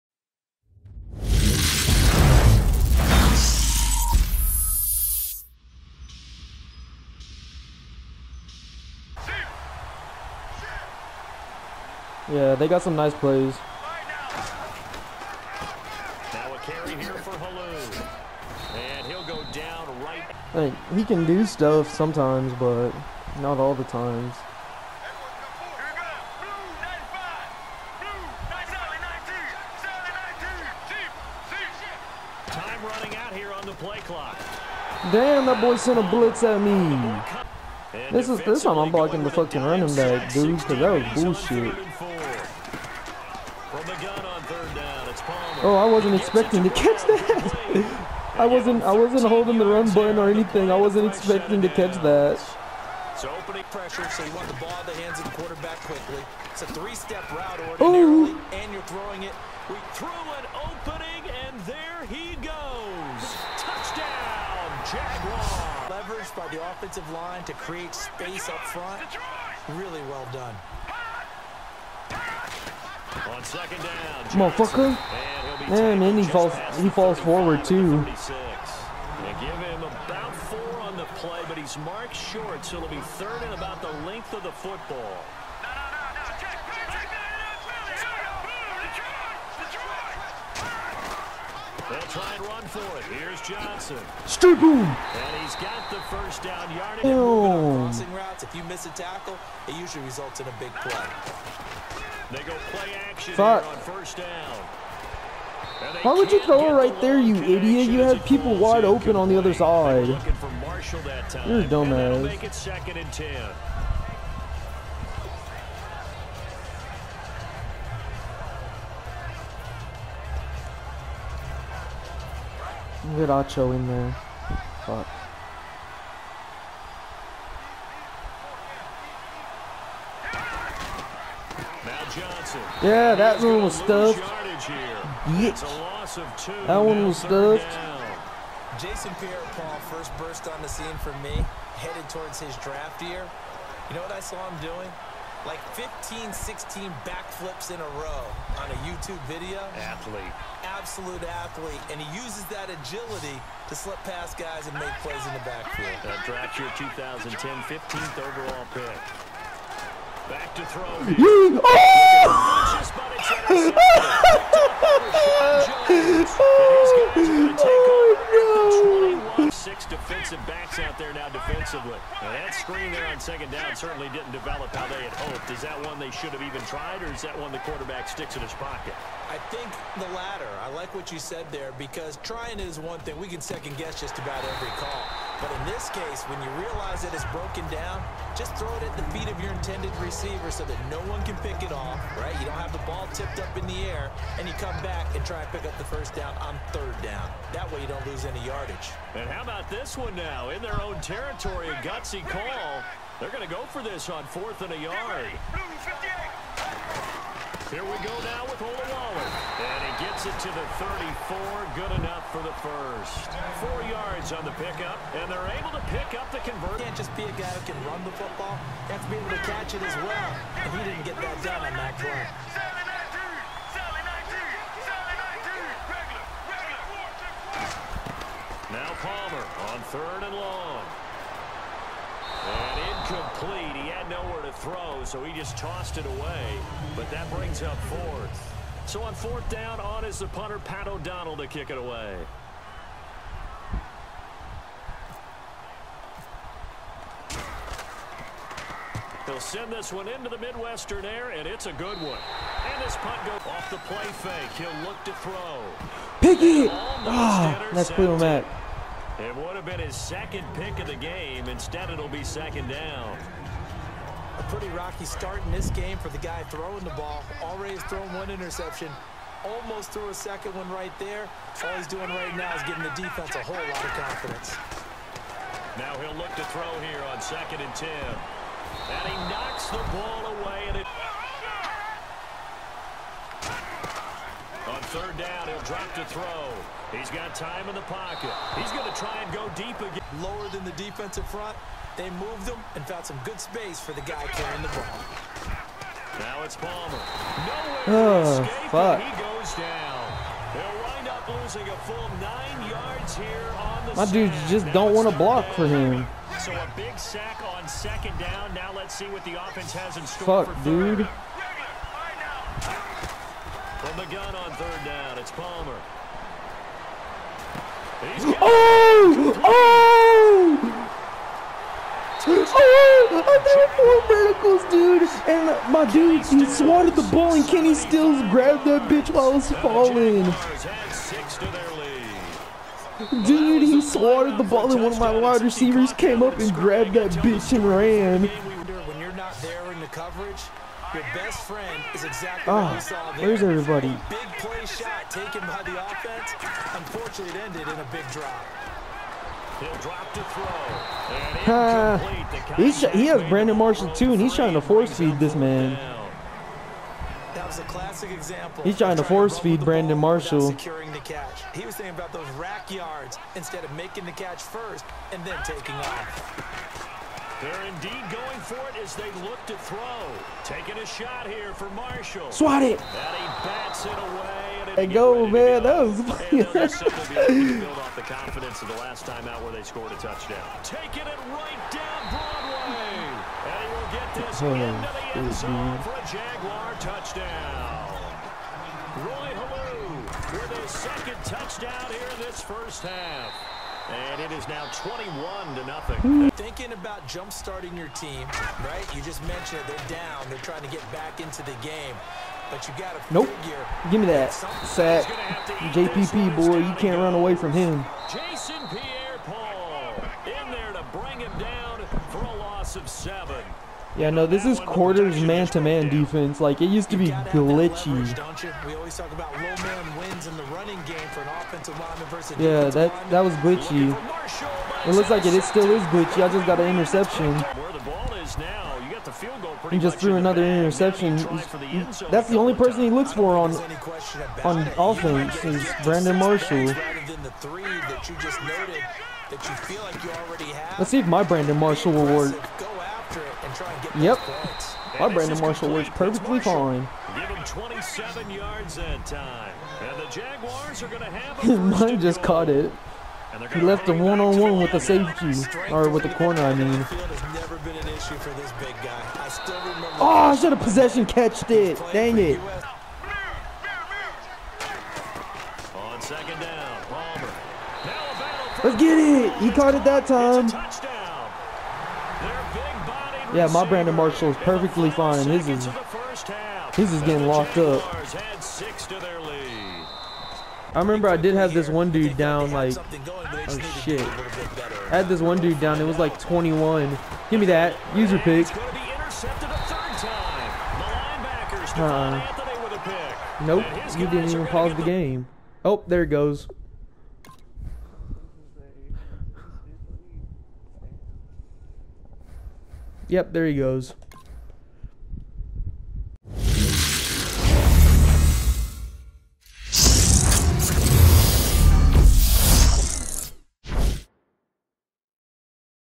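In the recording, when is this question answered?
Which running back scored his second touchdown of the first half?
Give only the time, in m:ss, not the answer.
6:29.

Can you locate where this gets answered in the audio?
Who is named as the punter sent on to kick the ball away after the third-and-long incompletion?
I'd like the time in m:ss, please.
4:00.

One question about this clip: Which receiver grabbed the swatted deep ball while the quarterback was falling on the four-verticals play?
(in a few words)
Kenny Stills.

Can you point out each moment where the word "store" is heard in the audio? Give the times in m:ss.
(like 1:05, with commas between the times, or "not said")
5:10.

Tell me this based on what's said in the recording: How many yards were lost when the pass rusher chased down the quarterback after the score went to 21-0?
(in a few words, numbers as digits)
7.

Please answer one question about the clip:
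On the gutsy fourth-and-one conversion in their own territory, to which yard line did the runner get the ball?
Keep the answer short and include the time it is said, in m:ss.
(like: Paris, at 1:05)
34, at 3:30.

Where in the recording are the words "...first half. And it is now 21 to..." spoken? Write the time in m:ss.
6:32.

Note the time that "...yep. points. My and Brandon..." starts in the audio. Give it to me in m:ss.
7:23.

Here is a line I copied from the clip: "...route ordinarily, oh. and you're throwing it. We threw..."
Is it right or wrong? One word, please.
right.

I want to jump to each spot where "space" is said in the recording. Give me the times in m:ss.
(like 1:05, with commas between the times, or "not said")
1:07, 4:53.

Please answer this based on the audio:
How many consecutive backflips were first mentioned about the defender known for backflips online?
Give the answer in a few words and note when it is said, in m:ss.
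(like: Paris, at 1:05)
15, at 2:25.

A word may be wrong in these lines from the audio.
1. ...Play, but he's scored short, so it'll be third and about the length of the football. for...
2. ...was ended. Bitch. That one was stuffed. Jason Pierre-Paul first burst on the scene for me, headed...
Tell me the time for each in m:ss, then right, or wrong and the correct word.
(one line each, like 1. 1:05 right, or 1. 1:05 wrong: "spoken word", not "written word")
1. 1:21 wrong: "marked", not "scored"
2. 2:13 wrong: "stuffed", not "ended".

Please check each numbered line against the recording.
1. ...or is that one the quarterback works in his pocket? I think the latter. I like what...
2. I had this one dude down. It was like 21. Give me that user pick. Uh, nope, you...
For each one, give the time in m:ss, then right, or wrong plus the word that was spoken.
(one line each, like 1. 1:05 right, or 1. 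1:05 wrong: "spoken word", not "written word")
1. 2:57 wrong: "sticks", not "works"
2. 8:04 right.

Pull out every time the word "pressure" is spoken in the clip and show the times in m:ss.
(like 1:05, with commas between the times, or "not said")
0:53.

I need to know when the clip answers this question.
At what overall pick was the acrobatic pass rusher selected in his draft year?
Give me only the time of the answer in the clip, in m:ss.
2:37.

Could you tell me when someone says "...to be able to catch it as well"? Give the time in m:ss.
3:39.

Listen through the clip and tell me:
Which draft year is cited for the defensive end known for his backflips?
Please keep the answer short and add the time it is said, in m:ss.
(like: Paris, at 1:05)
2010, at 2:36.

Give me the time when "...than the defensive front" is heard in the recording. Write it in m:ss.
4:50.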